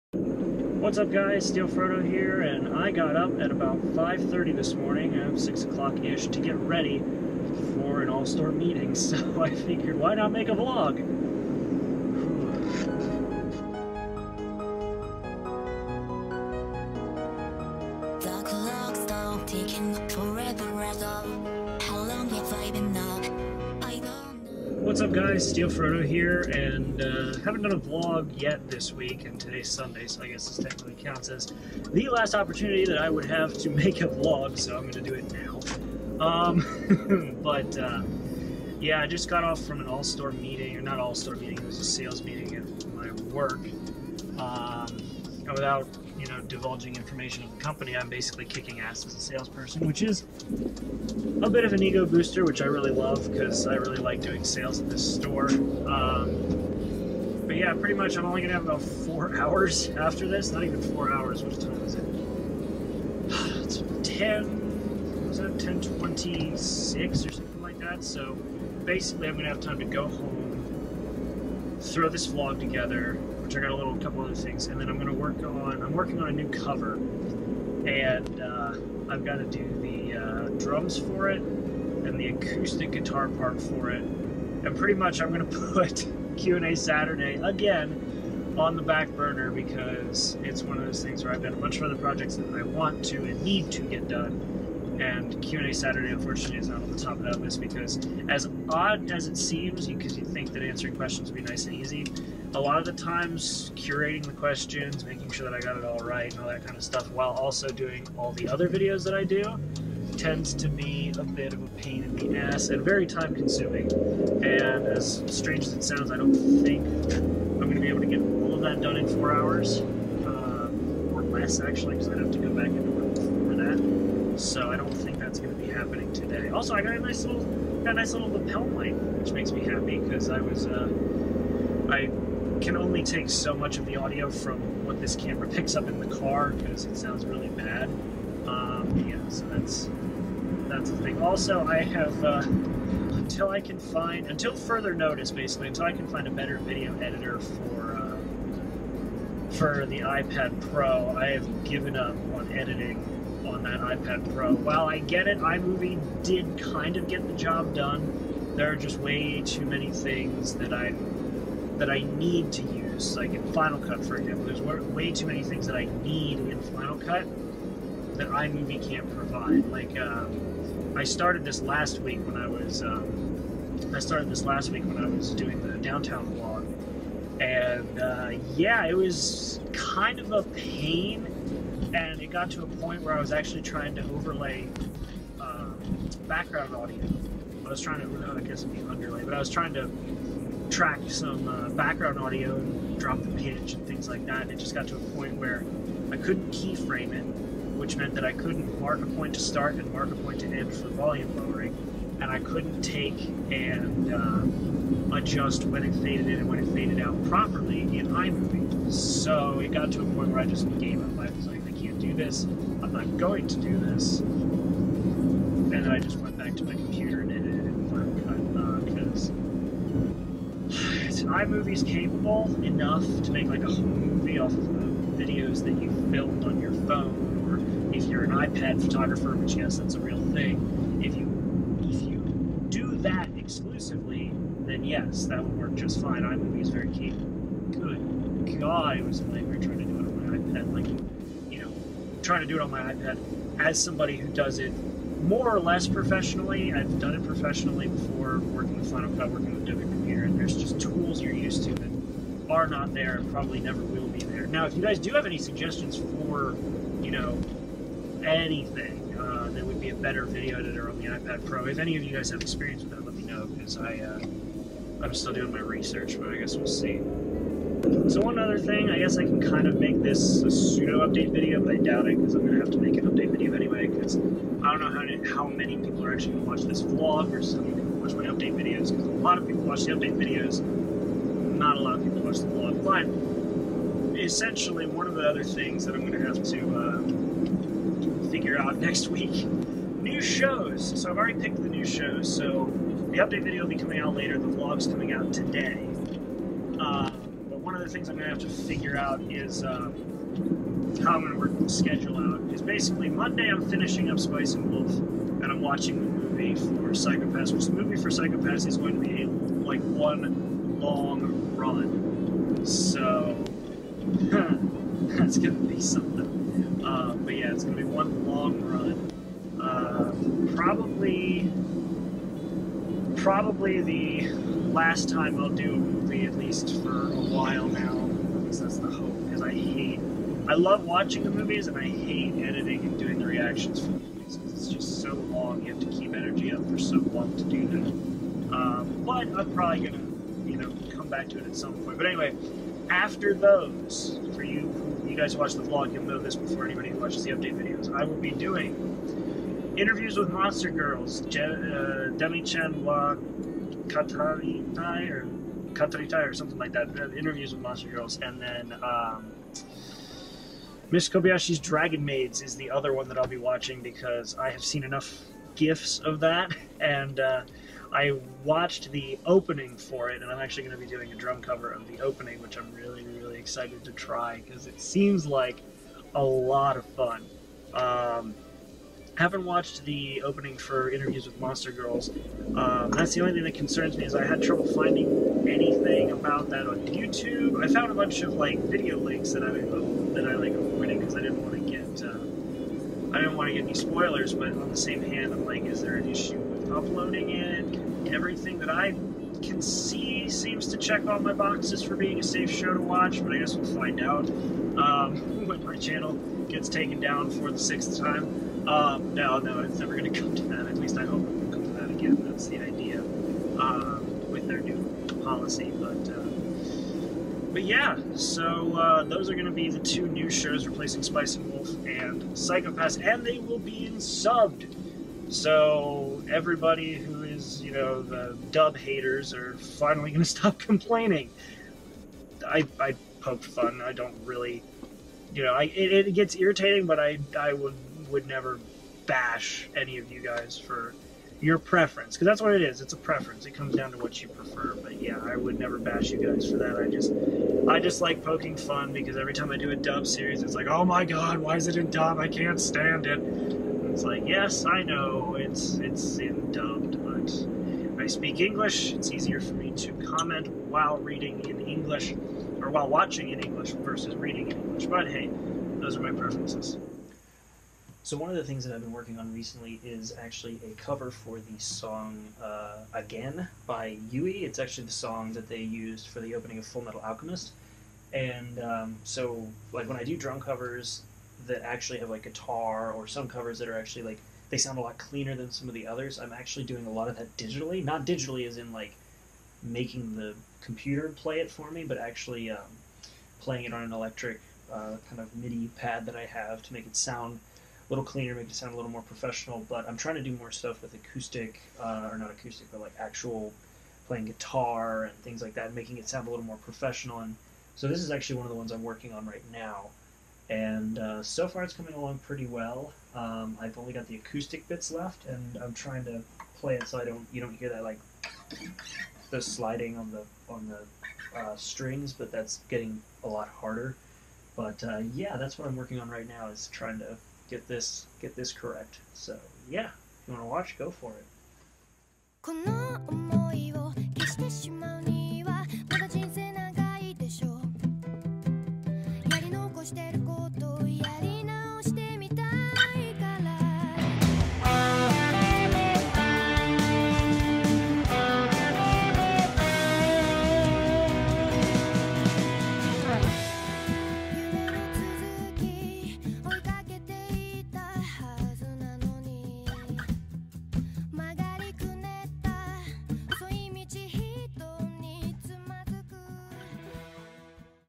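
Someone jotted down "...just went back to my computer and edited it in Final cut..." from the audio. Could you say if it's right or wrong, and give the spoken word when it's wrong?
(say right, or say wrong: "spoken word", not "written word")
right.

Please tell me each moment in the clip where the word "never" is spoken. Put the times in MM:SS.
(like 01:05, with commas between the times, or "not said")
04:13, 06:49, 07:18, 07:25.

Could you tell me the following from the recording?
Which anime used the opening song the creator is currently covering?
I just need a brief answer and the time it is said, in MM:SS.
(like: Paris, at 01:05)
Full Metal Alchemist, at 07:56.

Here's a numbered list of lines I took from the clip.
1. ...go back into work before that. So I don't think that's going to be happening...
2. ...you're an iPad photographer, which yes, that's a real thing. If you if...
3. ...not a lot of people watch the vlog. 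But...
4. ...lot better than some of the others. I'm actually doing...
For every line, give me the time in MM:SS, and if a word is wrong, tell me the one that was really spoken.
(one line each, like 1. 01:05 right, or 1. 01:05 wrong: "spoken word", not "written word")
1. 02:02 right
2. 03:48 right
3. 04:41 right
4. 08:04 wrong: "cleaner", not "better".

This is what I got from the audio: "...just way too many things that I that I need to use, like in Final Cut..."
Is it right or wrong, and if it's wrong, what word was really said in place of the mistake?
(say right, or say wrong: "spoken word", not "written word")
right.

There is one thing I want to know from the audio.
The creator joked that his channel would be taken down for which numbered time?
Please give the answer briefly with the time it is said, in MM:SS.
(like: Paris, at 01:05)
6th, at 06:47.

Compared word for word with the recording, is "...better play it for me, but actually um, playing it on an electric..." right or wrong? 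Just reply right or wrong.
wrong.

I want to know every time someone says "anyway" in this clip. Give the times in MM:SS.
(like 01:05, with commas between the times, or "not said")
04:33, 05:42.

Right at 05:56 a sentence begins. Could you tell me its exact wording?
Uh, interviews with monster girls, and then.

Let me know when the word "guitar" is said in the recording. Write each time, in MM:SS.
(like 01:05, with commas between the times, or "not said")
01:22, 08:02, 08:24.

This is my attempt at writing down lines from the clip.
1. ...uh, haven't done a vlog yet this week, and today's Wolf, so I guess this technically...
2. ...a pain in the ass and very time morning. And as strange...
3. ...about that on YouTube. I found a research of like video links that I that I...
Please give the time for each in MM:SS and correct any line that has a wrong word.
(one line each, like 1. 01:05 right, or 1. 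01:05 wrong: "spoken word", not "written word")
1. 00:27 wrong: "Sunday", not "Wolf"
2. 01:51 wrong: "consuming", not "morning"
3. 06:26 wrong: "bunch", not "research".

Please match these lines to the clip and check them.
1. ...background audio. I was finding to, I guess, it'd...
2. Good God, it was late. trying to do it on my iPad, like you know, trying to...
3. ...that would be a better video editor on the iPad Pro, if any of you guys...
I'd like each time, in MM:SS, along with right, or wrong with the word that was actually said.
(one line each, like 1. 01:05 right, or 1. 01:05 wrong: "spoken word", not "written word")
1. 03:06 wrong: "trying", not "finding"
2. 03:57 right
3. 04:19 right.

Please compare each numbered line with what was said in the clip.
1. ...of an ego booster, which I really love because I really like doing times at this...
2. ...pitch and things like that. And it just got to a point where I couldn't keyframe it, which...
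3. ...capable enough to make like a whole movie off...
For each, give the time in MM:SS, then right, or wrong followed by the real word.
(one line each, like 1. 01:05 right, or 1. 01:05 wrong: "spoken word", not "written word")
1. 00:51 wrong: "sales", not "times"
2. 03:13 right
3. 03:41 right.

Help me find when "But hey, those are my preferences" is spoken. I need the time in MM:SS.
07:44.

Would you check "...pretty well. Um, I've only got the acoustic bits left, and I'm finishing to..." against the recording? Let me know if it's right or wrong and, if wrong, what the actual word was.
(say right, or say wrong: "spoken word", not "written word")
wrong: "trying", not "finishing".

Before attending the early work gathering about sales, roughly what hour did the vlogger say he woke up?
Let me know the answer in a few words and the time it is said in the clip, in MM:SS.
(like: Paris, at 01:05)
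5:30, at 00:03.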